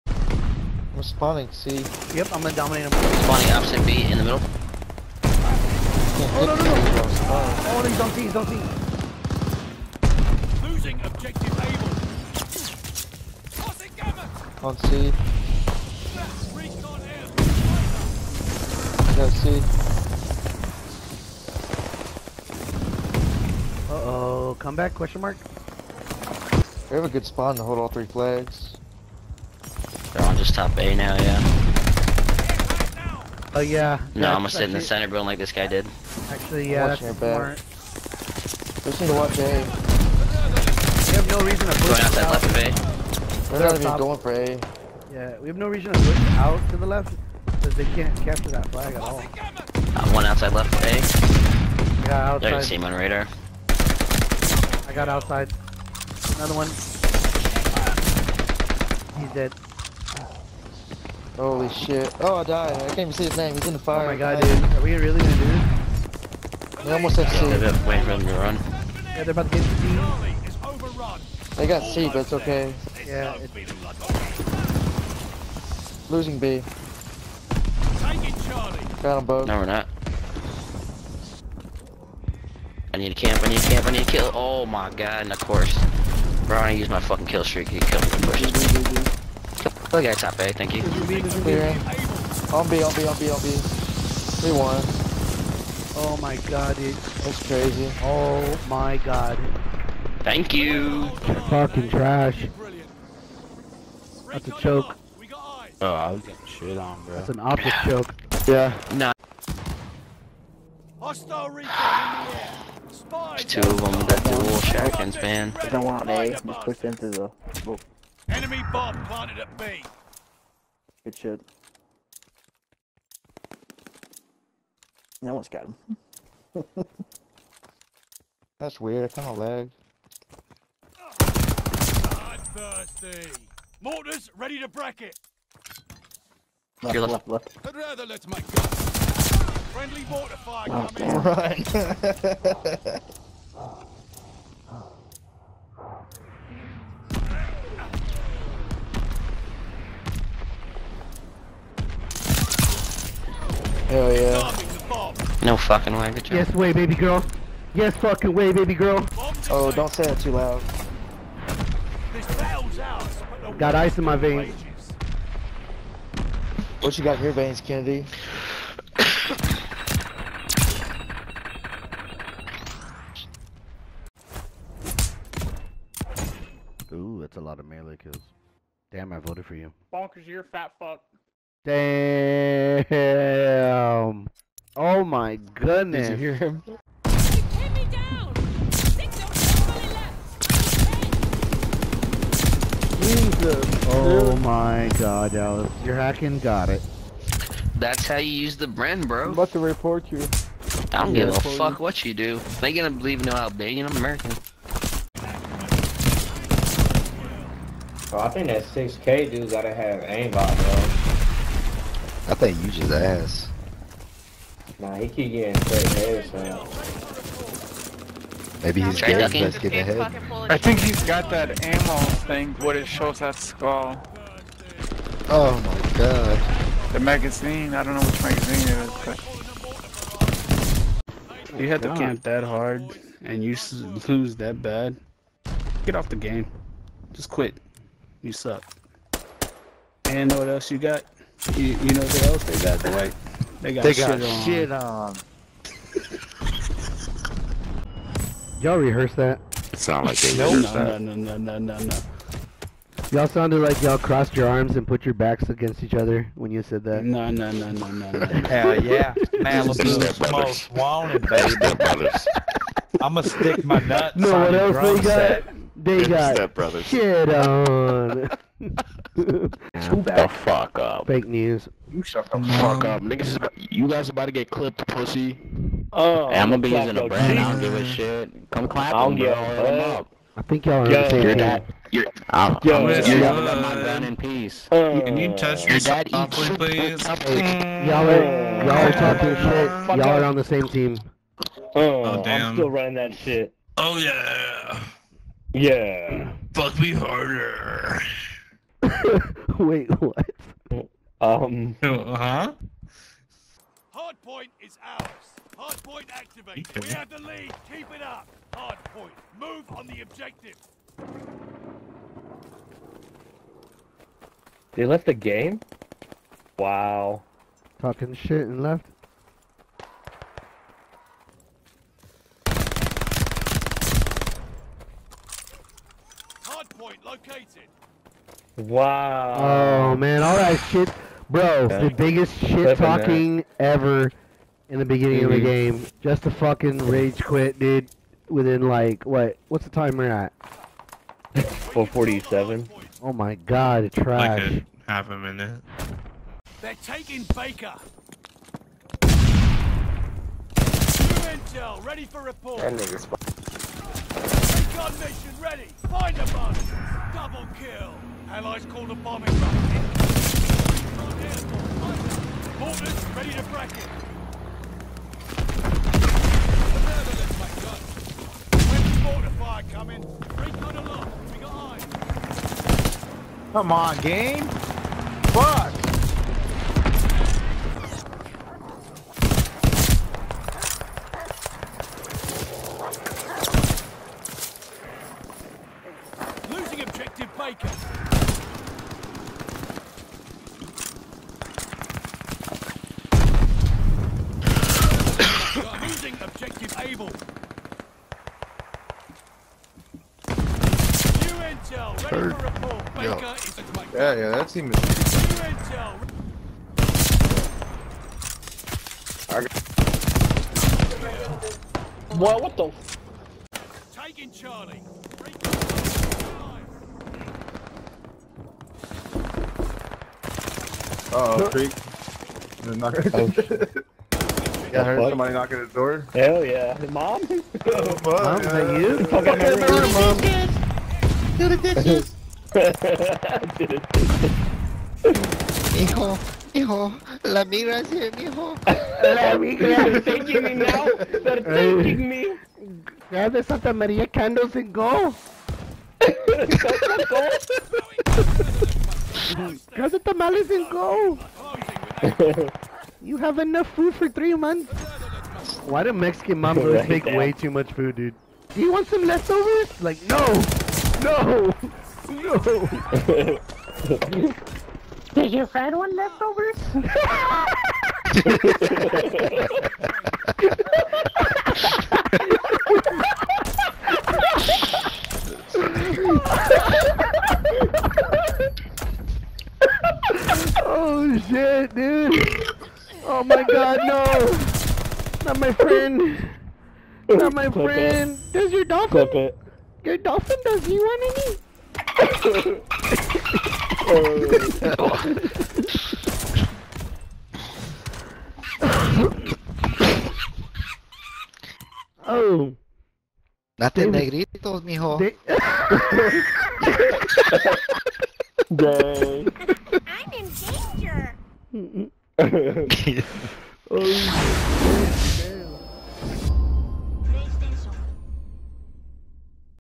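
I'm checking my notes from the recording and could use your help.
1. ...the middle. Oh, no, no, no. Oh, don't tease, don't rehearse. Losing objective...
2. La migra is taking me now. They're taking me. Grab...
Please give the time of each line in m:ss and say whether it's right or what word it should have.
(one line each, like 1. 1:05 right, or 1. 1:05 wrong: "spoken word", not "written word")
1. 0:04 wrong: "tease", not "rehearse"
2. 7:19 right.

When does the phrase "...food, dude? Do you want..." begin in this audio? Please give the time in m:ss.
7:37.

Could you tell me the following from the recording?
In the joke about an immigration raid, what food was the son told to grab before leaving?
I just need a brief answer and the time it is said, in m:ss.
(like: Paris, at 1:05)
tamales, at 7:30.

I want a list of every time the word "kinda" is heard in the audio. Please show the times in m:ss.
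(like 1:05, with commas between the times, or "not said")
2:09.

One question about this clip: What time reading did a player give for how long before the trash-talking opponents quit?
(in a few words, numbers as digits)
447.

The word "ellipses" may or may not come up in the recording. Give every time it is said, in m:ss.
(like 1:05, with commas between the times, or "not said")
not said.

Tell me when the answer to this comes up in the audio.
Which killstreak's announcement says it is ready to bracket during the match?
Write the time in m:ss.
2:13.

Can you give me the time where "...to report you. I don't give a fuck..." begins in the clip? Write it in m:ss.
3:19.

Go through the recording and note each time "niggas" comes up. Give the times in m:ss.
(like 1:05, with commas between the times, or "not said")
4:33, 5:52.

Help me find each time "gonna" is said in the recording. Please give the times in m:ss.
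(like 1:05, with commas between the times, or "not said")
0:02, 0:34, 1:05, 3:22, 4:23, 4:36, 4:40.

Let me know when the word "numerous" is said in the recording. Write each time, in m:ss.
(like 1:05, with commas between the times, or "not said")
not said.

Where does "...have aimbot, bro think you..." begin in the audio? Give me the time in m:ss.
3:29.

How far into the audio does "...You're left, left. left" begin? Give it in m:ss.
2:16.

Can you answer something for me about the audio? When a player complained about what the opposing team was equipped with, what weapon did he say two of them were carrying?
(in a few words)
dual shotguns.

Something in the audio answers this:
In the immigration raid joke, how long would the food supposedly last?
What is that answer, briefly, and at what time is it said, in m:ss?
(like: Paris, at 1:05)
3 months, at 7:34.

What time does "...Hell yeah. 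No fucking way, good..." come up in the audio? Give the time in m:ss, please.
2:33.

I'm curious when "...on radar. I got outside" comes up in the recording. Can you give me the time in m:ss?
0:52.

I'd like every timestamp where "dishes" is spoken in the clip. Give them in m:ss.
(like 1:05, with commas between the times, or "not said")
7:11.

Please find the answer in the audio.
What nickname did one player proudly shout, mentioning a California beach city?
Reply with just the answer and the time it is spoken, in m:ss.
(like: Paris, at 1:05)
Malibu's most wanted, at 4:19.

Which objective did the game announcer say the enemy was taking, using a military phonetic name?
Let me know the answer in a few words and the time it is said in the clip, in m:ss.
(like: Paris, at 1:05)
Baker, at 5:47.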